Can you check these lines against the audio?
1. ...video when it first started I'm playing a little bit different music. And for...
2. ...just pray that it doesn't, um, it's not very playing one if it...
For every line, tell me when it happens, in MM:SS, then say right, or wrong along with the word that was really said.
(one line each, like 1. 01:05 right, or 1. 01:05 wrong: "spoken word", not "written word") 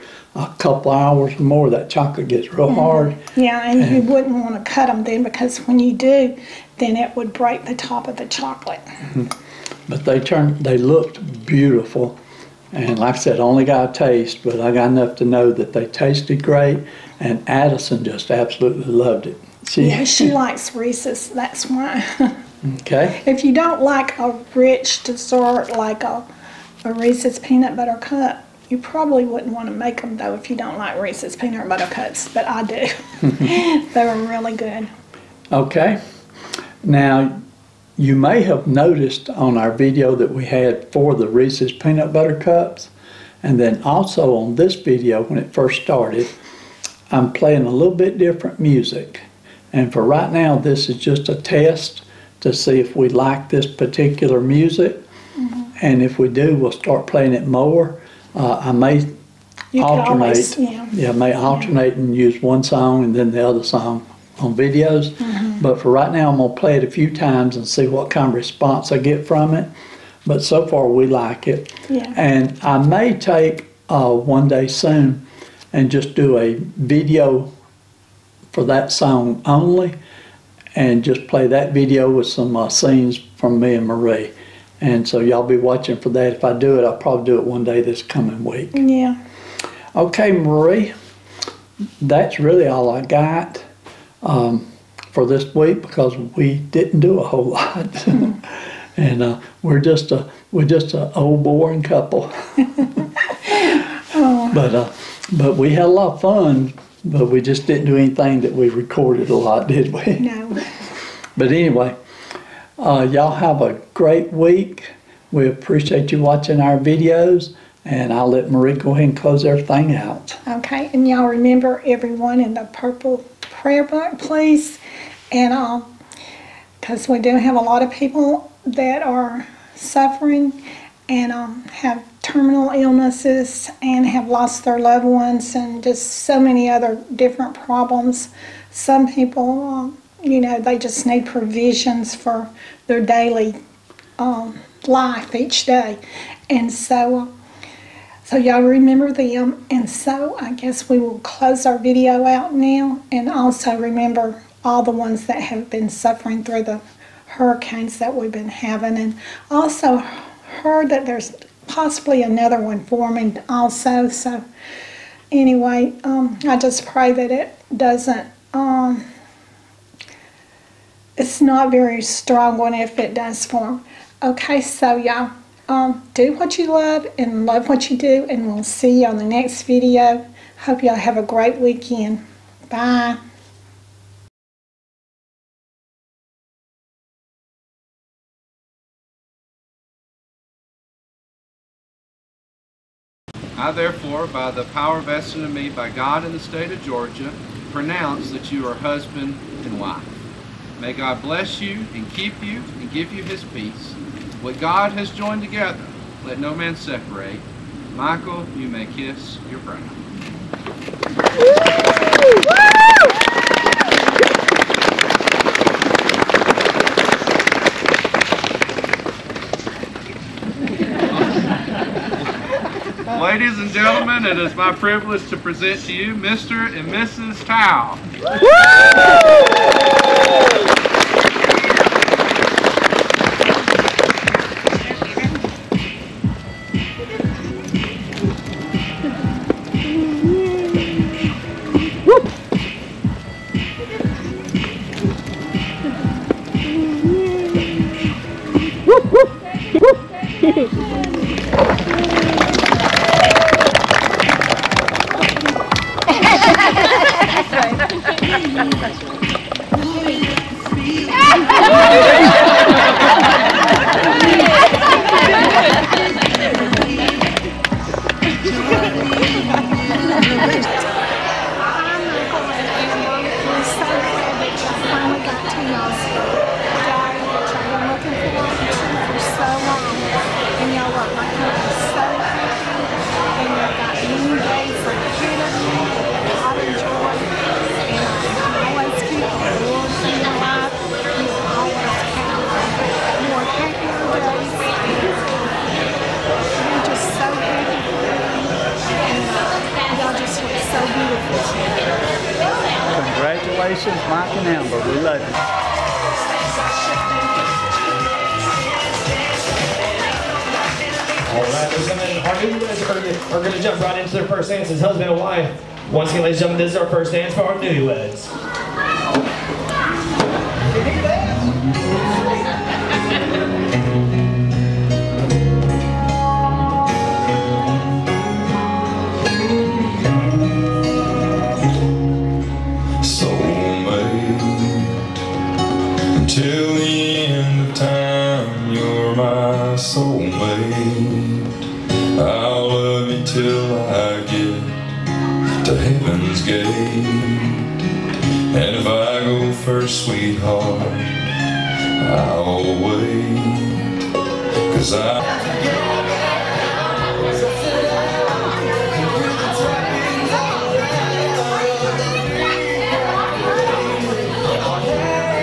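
1. 00:44 right
2. 02:46 wrong: "strong", not "playing".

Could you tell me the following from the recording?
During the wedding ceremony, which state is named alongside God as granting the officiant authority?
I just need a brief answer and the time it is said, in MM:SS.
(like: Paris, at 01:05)
Georgia, at 03:16.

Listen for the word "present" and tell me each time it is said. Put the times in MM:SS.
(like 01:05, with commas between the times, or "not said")
03:45.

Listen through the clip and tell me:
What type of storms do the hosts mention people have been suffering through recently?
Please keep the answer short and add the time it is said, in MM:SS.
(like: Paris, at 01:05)
hurricanes, at 02:37.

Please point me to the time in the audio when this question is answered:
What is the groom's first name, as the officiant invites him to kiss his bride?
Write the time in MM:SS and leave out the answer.
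03:27.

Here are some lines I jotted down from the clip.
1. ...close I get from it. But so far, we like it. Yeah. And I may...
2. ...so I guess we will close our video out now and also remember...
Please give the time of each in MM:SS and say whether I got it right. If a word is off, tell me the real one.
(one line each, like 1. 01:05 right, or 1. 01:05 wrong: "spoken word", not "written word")
1. 01:08 wrong: "response", not "close"
2. 02:29 right.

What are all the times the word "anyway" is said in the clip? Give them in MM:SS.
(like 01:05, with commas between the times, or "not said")
01:51, 02:45.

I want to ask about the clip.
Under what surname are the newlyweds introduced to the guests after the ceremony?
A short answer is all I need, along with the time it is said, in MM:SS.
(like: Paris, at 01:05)
Tao, at 03:47.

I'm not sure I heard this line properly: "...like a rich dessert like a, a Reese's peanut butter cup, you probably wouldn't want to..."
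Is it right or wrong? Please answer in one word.
right.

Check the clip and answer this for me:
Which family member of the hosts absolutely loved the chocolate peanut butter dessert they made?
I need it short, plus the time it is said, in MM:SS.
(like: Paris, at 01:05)
Addison, at 00:17.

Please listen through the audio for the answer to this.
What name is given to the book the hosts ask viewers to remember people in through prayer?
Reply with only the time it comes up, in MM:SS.
02:02.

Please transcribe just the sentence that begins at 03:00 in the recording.
Hope y'all have a great weekend.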